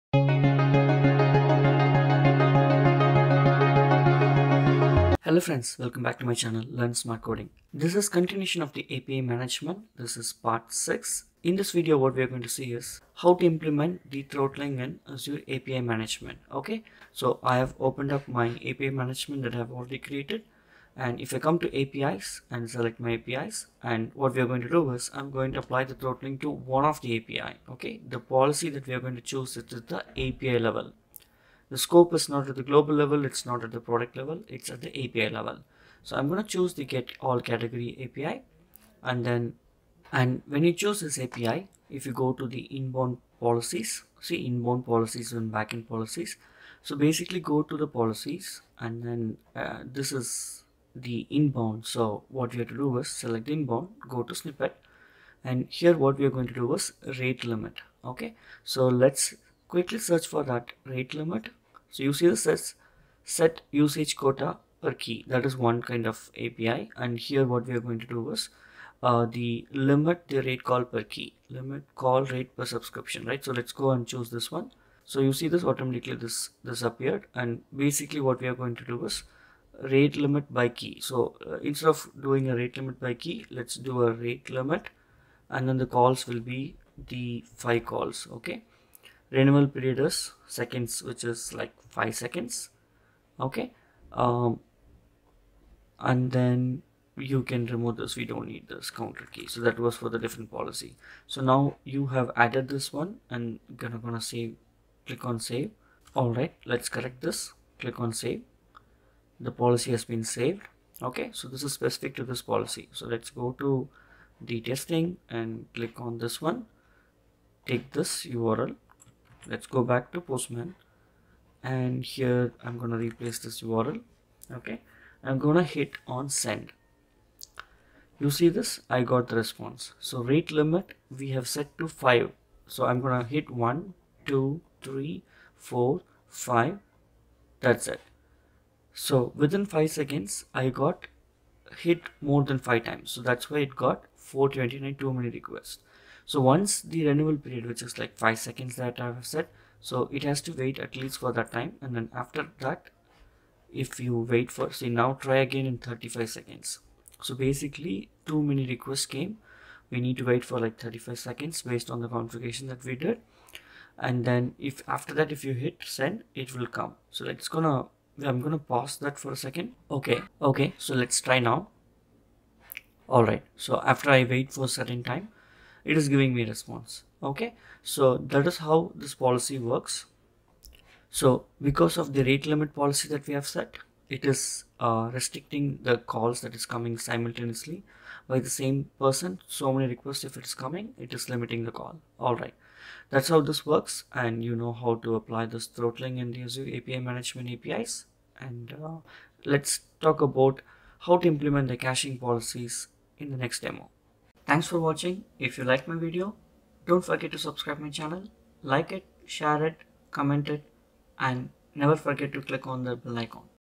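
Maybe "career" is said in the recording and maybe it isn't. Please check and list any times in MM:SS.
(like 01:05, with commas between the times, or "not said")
not said.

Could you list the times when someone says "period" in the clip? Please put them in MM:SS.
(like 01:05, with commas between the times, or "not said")
01:29, 02:27.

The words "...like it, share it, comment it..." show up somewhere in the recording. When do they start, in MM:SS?
03:28.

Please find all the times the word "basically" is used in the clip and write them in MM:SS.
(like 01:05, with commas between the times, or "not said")
00:46, 01:17, 02:37.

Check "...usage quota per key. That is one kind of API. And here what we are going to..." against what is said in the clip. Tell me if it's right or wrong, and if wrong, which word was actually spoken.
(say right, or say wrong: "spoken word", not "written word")
right.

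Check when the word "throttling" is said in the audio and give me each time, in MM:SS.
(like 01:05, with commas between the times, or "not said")
00:14, 00:25, 03:15.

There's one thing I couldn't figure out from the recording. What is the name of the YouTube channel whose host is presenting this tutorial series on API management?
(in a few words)
Learn Smart Coding.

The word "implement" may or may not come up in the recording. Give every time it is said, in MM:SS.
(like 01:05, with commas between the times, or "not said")
00:13, 03:21.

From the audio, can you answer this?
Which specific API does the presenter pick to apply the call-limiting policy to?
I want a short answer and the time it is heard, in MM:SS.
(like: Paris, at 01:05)
get all category, at 00:36.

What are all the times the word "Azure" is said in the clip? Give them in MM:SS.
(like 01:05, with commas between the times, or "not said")
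00:15, 03:16.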